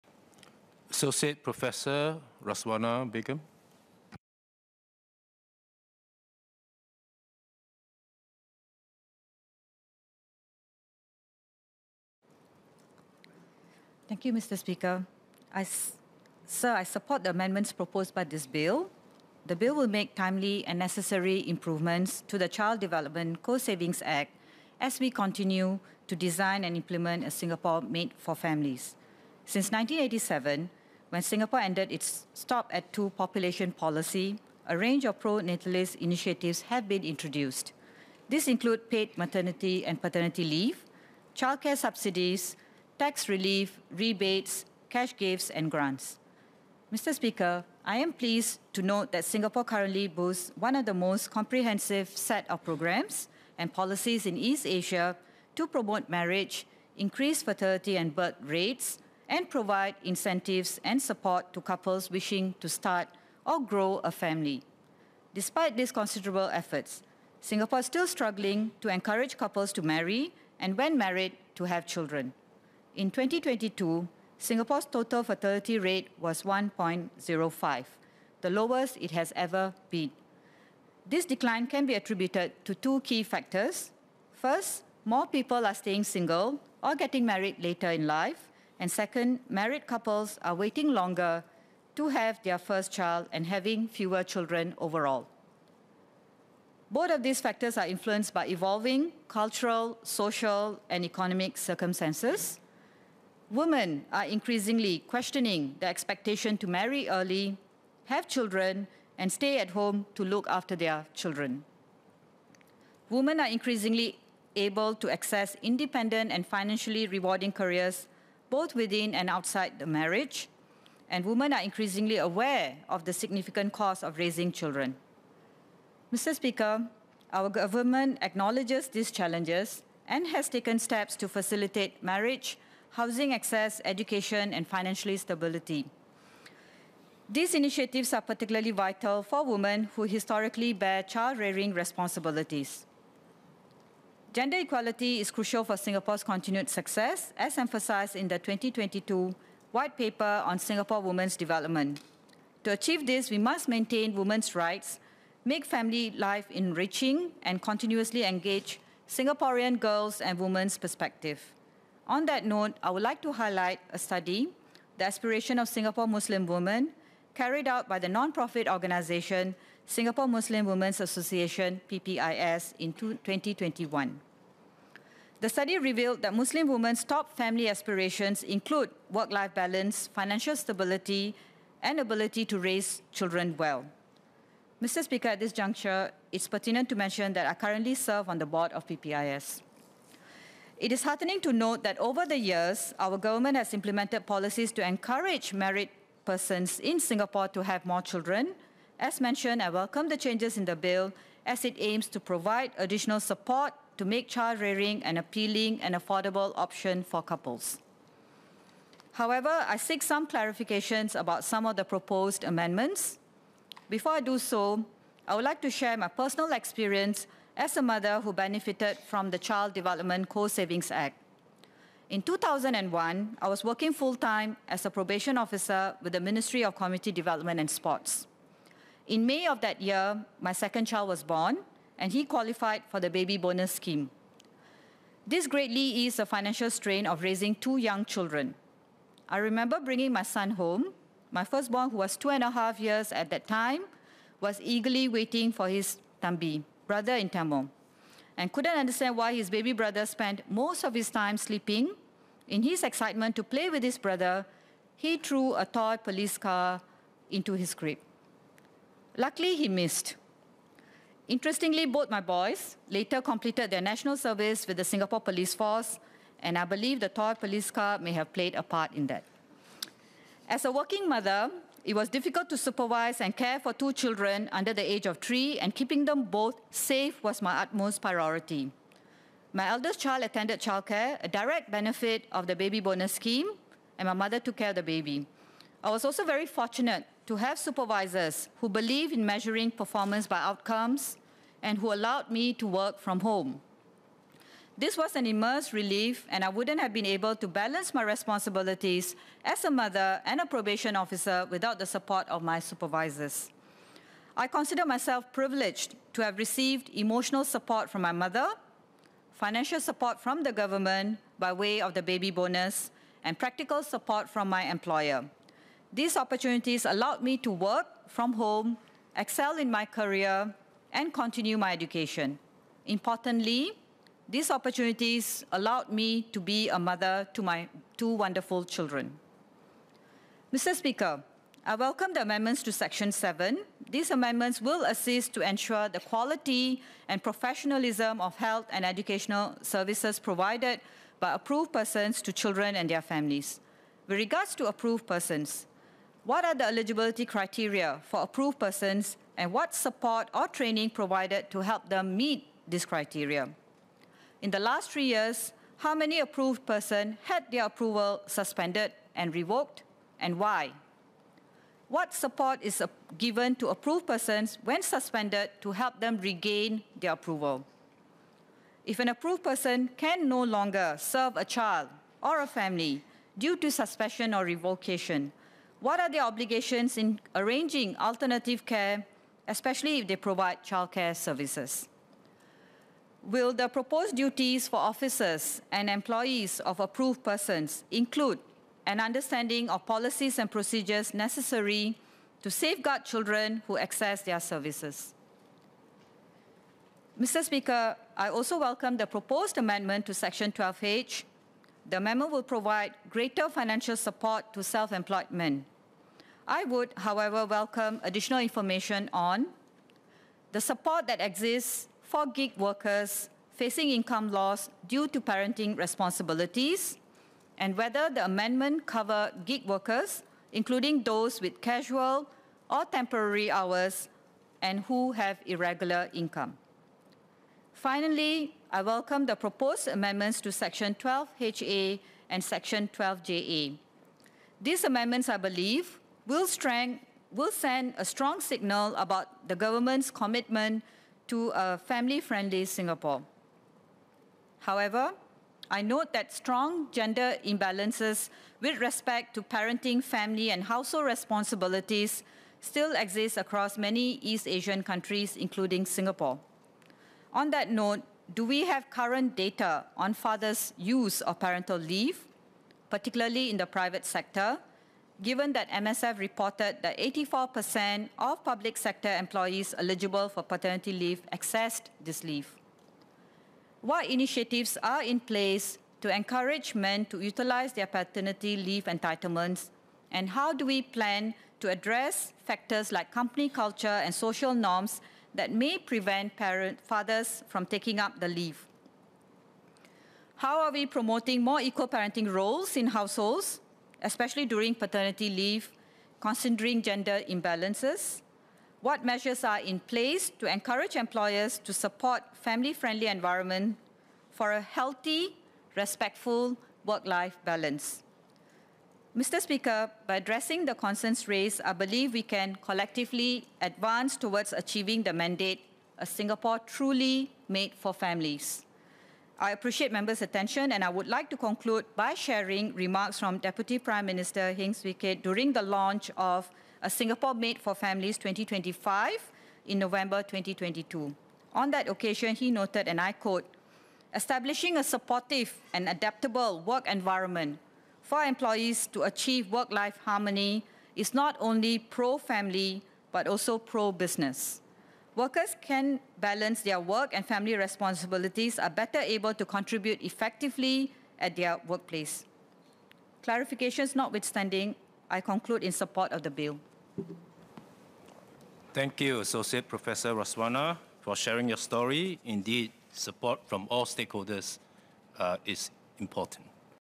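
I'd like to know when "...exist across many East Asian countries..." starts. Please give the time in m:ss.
7:32.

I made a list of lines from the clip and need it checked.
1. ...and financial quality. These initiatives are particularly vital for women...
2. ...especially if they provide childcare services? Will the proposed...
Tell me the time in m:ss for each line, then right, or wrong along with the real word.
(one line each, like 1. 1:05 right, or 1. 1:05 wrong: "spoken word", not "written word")
1. 2:14 wrong: "stability", not "quality"
2. 6:19 right.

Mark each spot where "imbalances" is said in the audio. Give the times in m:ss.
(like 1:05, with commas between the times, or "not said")
7:27, 8:17.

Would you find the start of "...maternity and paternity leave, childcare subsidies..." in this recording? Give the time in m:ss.
0:39.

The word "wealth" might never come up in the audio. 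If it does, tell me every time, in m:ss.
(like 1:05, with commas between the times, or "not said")
not said.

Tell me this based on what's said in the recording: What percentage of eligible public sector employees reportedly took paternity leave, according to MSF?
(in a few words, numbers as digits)
84%.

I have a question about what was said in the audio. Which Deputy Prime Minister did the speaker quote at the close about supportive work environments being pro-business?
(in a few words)
Heng Swee Keat.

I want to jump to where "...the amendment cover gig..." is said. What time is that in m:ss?
6:58.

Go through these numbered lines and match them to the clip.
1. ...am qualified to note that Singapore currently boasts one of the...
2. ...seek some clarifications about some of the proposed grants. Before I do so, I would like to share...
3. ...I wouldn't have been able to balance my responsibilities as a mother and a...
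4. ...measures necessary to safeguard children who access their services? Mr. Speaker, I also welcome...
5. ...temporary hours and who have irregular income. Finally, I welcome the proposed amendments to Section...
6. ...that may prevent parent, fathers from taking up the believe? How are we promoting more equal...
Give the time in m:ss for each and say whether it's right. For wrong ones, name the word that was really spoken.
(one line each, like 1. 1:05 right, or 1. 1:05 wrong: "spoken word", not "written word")
1. 0:47 wrong: "pleased", not "qualified"
2. 3:29 wrong: "amendments", not "grants"
3. 4:56 right
4. 6:30 wrong: "procedures", not "measures"
5. 7:02 right
6. 8:05 wrong: "leave", not "believe".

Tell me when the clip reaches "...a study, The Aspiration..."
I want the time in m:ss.
2:43.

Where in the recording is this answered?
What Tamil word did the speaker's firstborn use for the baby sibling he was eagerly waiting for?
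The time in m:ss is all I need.
4:06.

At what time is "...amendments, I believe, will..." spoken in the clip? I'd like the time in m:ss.
7:14.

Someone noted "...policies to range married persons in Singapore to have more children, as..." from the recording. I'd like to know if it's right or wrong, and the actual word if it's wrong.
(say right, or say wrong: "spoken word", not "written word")
wrong: "encourage", not "range".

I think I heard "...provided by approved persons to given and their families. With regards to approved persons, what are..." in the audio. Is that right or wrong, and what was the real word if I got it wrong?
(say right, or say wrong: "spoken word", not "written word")
wrong: "children", not "given".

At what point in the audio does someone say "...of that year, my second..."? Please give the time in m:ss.
3:49.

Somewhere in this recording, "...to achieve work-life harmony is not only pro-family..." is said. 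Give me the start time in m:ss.
8:58.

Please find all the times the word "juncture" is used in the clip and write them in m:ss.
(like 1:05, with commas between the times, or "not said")
3:05.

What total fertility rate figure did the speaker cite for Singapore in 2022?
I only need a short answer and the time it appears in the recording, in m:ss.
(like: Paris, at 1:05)
1.05, at 1:16.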